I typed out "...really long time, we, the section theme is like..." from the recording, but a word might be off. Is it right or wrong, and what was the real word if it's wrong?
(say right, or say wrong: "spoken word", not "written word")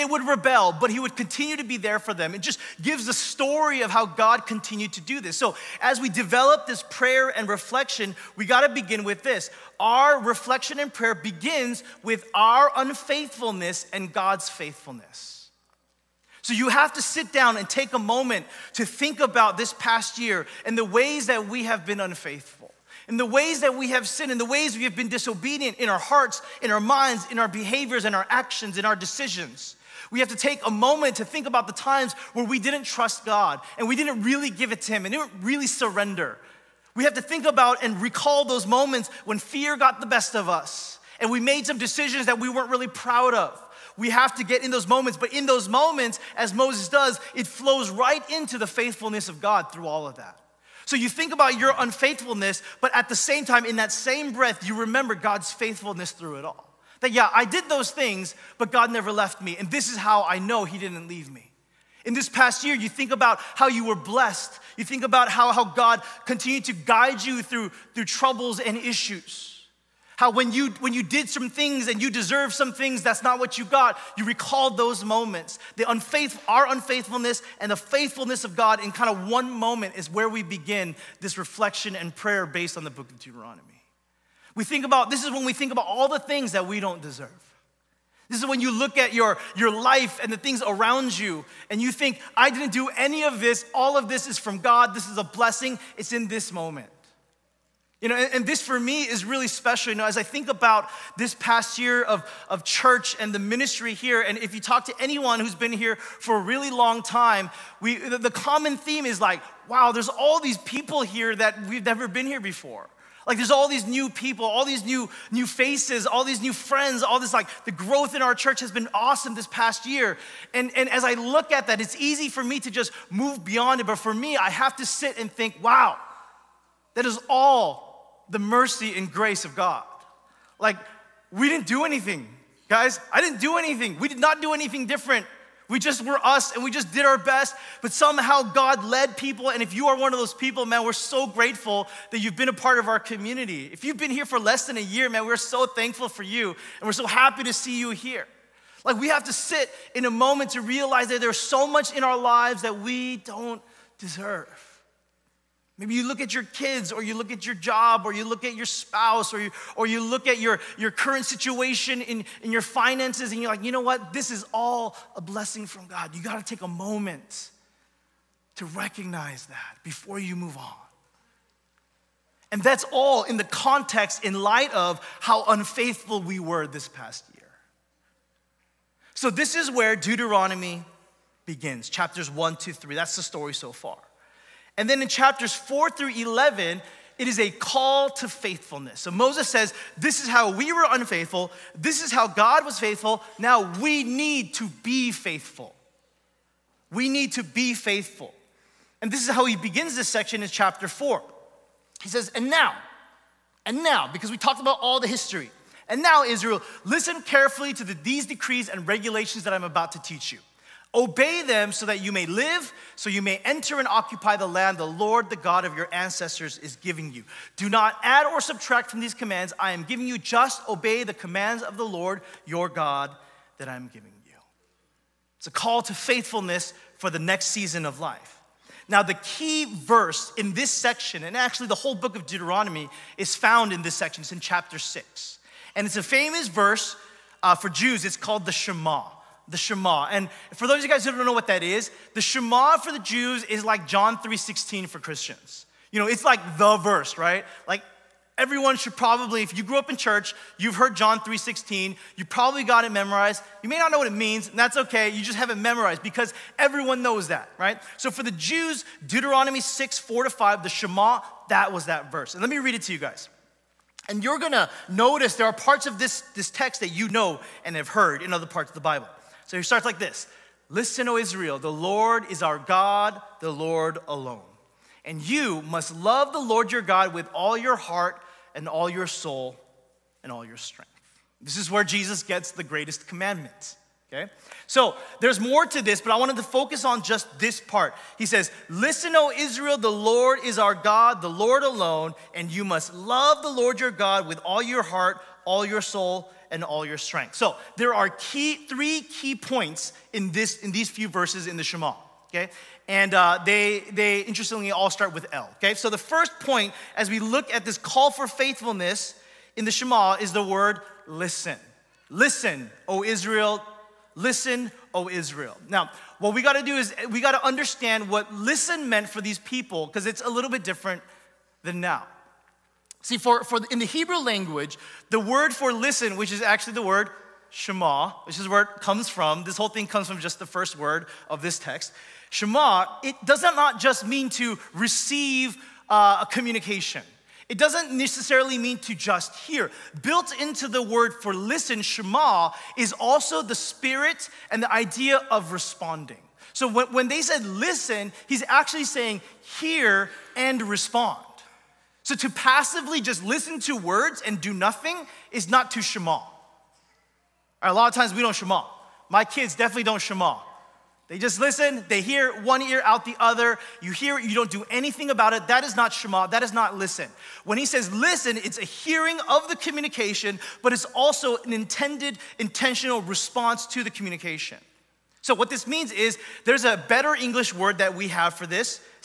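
wrong: "common", not "section".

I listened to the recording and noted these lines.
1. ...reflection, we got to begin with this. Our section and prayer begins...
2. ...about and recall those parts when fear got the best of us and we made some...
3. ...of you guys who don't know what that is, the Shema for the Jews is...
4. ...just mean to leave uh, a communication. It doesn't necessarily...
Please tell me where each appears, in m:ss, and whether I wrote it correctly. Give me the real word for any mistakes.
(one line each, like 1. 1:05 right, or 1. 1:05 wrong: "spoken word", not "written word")
1. 0:07 wrong: "reflection", not "section"
2. 0:37 wrong: "moments", not "parts"
3. 4:00 right
4. 5:33 wrong: "receive", not "leave".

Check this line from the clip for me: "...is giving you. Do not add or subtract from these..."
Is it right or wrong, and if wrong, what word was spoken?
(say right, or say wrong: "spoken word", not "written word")
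right.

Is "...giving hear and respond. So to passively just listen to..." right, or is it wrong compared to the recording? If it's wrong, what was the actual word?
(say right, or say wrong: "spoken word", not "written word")
wrong: "saying", not "giving".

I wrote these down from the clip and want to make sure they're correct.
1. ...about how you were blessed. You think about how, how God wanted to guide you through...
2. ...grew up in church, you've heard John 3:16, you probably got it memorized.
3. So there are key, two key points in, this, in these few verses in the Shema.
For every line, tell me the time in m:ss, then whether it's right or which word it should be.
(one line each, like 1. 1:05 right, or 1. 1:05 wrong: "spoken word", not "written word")
1. 1:03 wrong: "continued", not "wanted"
2. 4:09 right
3. 4:57 wrong: "three", not "two".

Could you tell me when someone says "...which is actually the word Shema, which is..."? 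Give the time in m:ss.
5:26.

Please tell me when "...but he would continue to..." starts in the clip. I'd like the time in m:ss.
0:00.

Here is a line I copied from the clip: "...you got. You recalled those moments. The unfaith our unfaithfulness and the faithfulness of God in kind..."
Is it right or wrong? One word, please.
right.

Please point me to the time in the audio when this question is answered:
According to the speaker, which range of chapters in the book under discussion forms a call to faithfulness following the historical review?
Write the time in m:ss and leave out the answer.
3:05.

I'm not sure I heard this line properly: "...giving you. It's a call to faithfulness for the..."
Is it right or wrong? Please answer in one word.
right.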